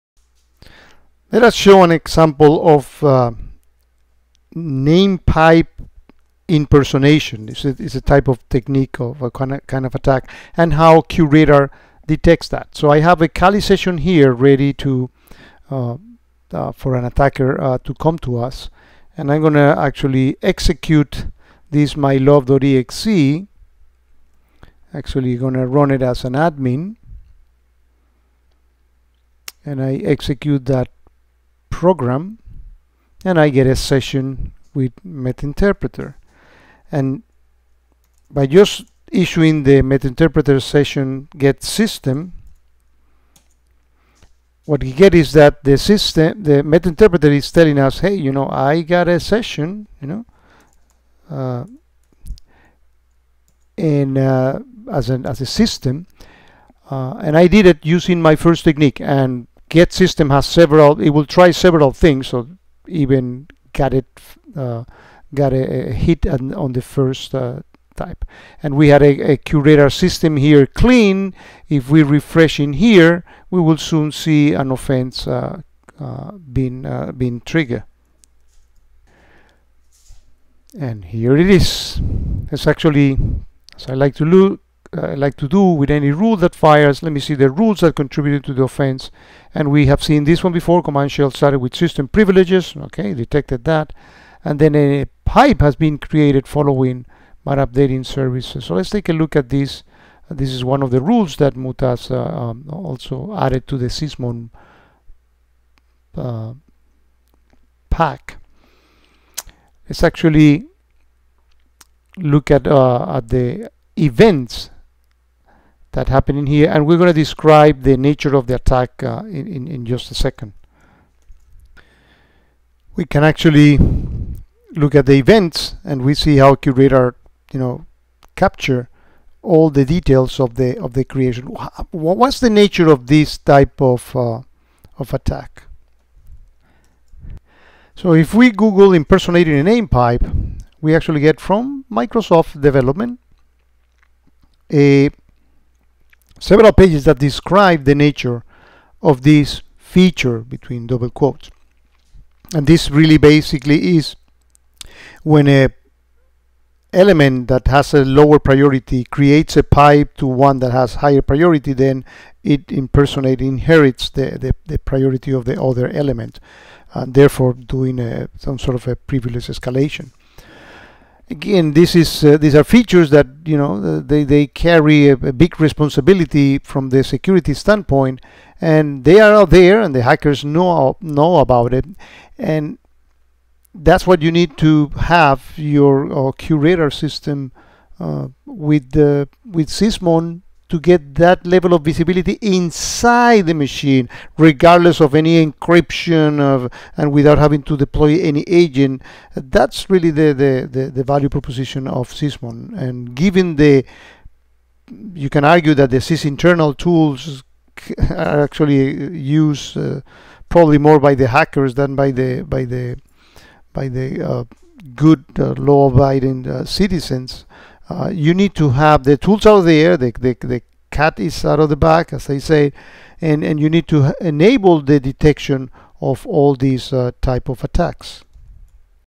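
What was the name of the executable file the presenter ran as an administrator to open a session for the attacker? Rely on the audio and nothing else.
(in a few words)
mylove.exe.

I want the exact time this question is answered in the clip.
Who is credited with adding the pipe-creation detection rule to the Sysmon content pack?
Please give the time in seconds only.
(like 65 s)
101 s.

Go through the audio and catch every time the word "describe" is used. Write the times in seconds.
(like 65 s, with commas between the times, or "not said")
117 s, 147 s.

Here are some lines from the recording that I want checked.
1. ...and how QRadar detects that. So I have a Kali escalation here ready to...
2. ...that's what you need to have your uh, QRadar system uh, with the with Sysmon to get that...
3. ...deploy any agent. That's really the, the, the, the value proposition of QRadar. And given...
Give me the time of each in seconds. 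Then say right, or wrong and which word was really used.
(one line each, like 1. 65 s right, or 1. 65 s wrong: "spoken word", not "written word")
1. 10 s wrong: "session", not "escalation"
2. 183 s right
3. 197 s wrong: "Sysmon", not "QRadar".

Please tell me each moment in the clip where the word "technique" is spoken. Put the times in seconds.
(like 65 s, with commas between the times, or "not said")
8 s, 58 s.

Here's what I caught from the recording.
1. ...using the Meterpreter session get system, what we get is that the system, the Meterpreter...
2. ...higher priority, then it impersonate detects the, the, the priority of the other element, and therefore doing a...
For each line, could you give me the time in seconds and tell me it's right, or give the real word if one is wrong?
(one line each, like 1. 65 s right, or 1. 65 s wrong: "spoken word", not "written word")
1. 39 s wrong: "issuing", not "using"
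2. 160 s wrong: "inherits", not "detects".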